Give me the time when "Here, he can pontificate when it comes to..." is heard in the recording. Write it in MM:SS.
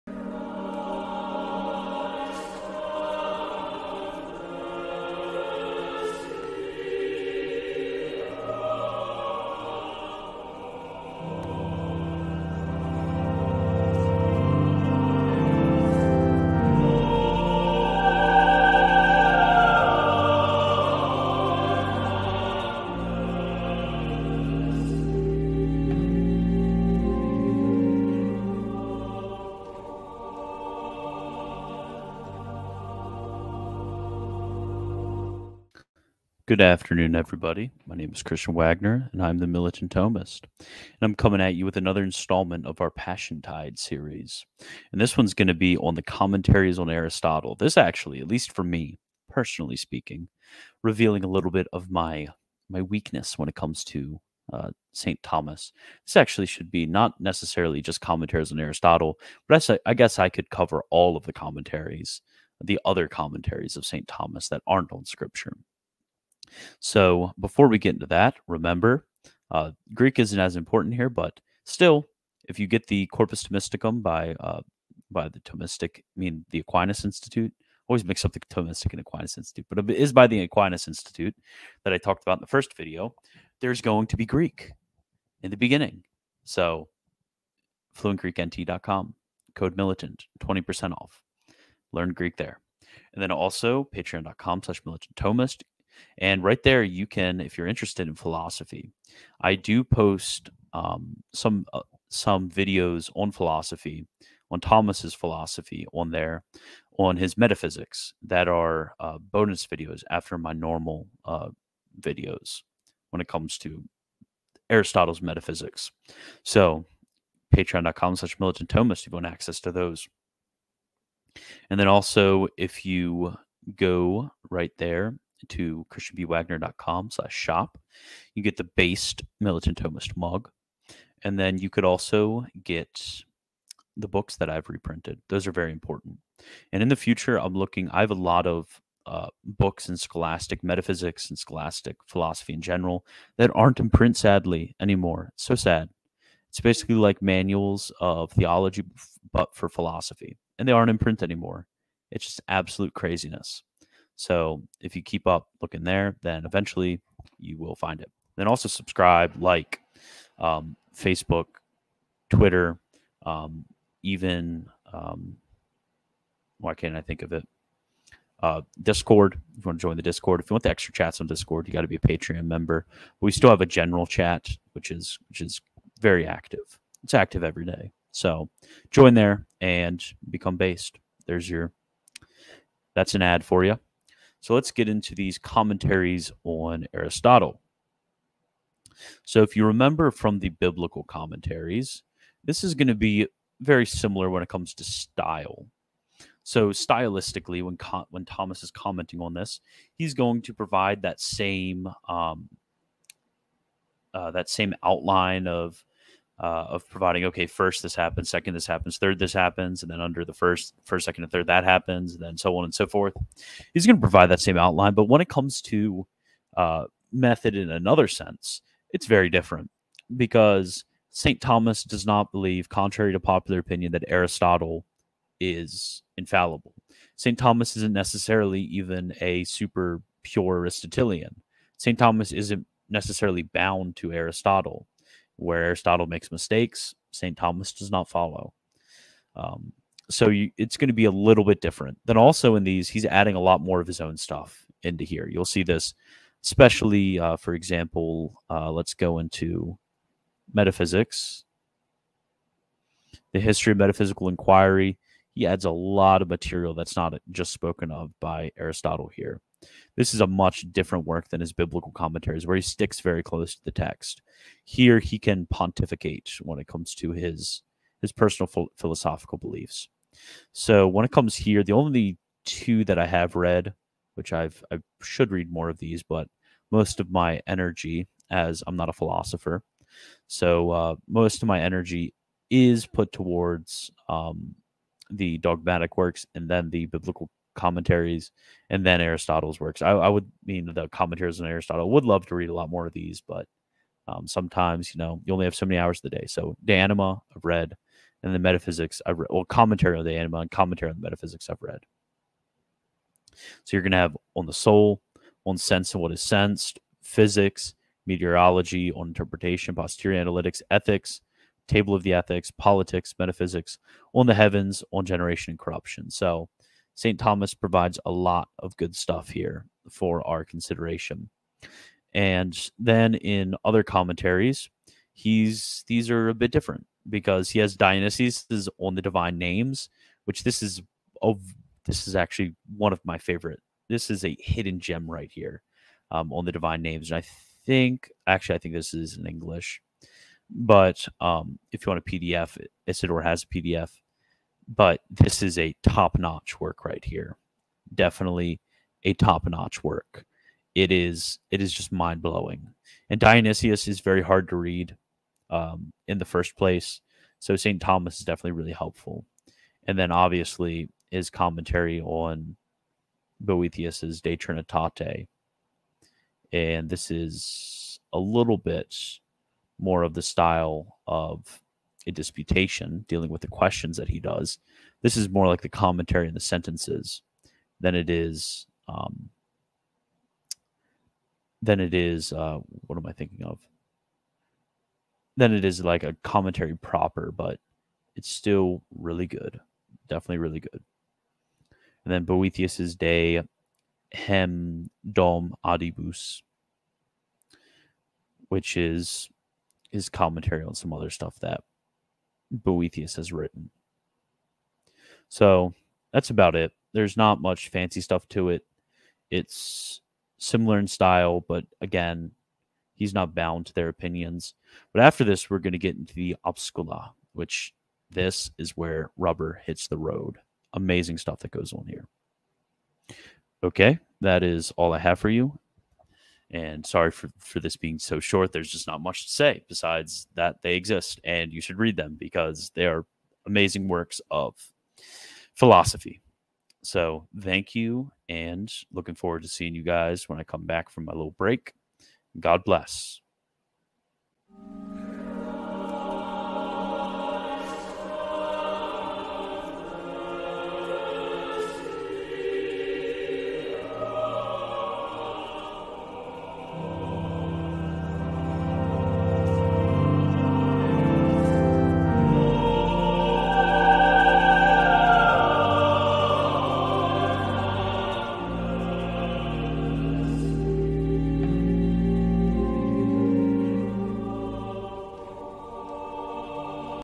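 04:24.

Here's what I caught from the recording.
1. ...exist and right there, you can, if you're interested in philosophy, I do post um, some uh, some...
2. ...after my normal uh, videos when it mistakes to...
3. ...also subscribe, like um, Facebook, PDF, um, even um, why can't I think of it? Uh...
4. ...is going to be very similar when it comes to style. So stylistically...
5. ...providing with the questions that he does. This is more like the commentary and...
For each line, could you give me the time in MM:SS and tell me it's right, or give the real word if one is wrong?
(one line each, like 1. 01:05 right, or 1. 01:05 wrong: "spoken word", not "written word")
1. 01:35 wrong: "thomist", not "exist"
2. 01:50 wrong: "comes", not "mistakes"
3. 02:38 wrong: "Twitter", not "PDF"
4. 03:12 right
5. 06:13 wrong: "dealing", not "providing".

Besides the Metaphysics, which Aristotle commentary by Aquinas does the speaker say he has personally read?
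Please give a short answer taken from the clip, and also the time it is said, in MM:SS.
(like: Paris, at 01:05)
De Anima, at 04:56.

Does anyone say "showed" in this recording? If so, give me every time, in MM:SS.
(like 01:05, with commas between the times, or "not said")
not said.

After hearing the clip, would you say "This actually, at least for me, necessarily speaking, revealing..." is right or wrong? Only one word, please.
wrong.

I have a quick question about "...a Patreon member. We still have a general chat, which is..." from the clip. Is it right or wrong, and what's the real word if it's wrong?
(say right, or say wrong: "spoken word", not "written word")
right.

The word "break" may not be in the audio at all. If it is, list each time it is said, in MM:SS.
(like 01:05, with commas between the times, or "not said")
07:21.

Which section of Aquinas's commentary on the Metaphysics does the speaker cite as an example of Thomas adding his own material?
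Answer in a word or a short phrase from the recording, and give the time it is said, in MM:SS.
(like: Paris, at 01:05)
history of metaphysical inquiry, at 04:13.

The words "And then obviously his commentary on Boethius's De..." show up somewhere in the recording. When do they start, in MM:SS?
05:59.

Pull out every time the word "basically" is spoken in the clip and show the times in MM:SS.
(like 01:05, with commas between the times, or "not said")
02:26.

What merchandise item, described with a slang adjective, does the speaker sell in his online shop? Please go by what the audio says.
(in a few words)
Militant Thomist mug.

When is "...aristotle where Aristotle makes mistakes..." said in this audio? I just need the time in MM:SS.
03:54.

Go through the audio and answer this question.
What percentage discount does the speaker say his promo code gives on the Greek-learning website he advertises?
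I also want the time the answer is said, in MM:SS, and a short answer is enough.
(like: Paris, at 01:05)
20%, at 01:30.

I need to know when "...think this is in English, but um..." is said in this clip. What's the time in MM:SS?
05:38.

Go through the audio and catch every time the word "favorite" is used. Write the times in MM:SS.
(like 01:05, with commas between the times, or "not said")
05:33.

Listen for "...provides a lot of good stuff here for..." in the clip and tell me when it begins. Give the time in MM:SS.
05:17.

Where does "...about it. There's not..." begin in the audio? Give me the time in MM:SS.
06:46.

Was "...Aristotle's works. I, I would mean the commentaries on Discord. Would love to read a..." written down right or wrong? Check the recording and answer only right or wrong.
wrong.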